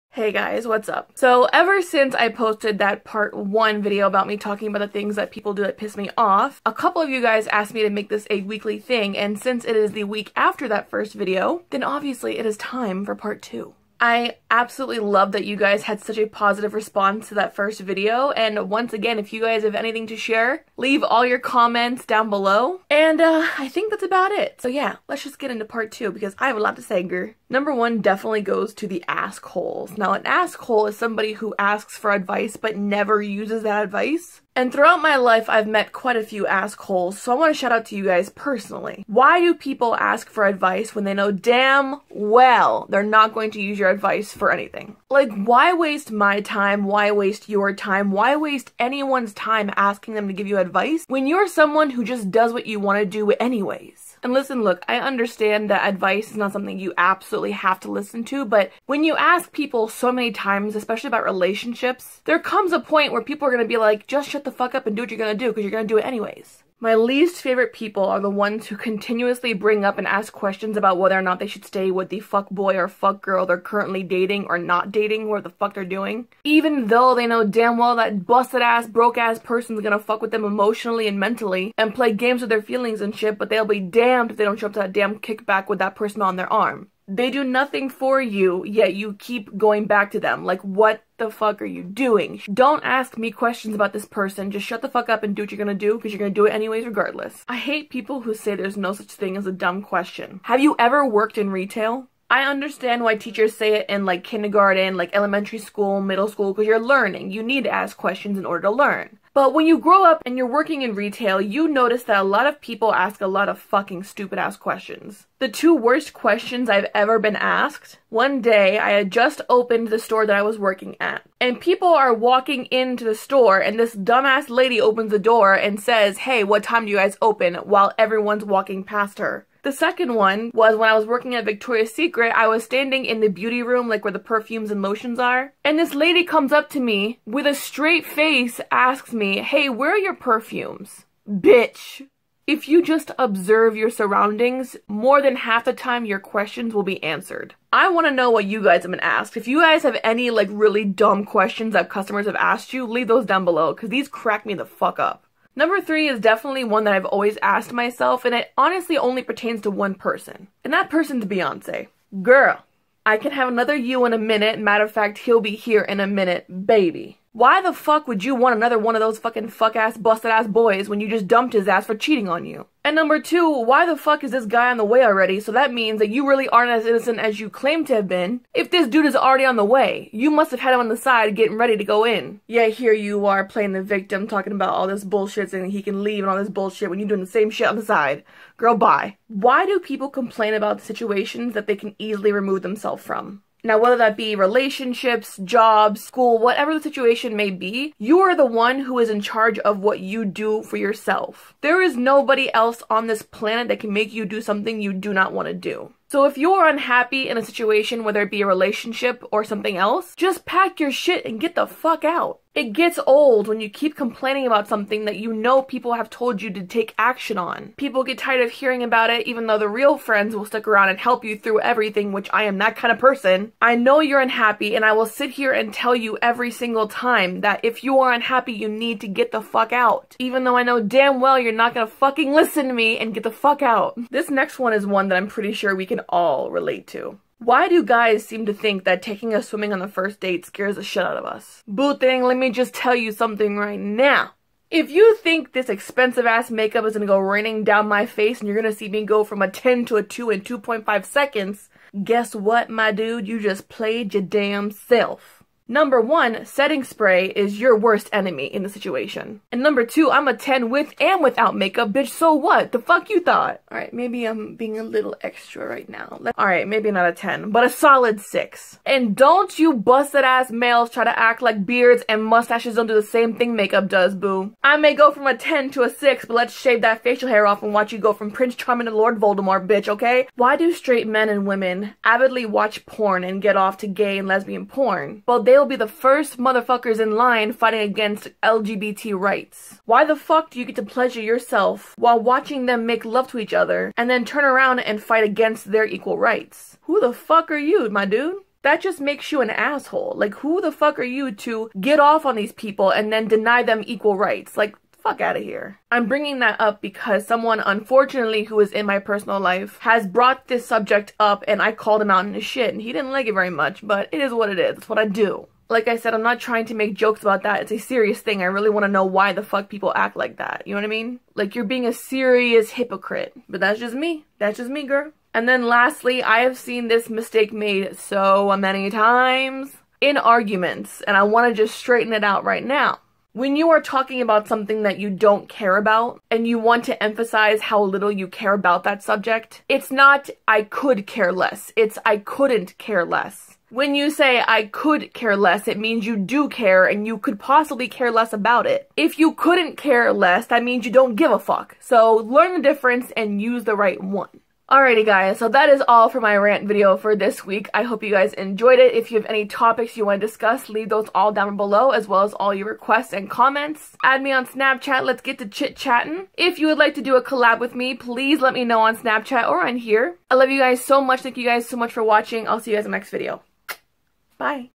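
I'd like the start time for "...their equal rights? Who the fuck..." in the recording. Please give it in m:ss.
4:55.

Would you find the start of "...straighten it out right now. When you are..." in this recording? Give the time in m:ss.
5:31.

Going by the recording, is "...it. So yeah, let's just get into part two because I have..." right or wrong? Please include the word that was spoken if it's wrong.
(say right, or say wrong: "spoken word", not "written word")
right.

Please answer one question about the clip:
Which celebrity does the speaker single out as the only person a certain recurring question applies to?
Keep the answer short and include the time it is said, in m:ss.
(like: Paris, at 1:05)
Beyonce, at 2:41.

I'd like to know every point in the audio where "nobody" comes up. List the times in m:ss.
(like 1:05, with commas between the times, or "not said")
3:21.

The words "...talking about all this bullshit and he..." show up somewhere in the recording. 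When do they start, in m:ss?
3:04.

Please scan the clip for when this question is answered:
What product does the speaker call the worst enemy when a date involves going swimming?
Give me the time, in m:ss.
4:16.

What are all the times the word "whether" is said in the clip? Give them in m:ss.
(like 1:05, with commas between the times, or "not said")
1:10, 3:13, 3:28.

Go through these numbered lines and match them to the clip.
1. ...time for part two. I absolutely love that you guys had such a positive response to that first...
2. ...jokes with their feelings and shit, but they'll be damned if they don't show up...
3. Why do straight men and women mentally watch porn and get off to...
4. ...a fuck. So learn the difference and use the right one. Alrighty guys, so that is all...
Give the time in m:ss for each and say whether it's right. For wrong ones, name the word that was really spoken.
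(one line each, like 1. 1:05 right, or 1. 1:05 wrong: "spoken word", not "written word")
1. 0:12 right
2. 1:22 wrong: "games", not "jokes"
3. 4:40 wrong: "avidly", not "mentally"
4. 5:51 right.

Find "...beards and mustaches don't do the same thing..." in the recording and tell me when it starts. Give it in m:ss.
4:31.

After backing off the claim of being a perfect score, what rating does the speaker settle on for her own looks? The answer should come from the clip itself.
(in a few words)
6.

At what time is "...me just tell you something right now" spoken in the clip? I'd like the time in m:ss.
4:02.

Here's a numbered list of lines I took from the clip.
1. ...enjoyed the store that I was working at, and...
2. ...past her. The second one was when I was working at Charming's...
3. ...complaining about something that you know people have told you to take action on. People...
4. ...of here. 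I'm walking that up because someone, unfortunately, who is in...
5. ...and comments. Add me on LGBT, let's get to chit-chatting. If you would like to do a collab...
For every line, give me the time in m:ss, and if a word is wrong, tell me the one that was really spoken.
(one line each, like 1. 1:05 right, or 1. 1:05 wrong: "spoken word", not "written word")
1. 1:59 wrong: "opened", not "enjoyed"
2. 2:08 wrong: "Victoria", not "Charming"
3. 3:33 right
4. 5:05 wrong: "bringing", not "walking"
5. 6:03 wrong: "Snapchat", not "LGBT".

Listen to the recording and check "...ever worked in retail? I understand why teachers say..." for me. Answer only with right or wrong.
right.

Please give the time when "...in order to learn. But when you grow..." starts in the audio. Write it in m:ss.
1:48.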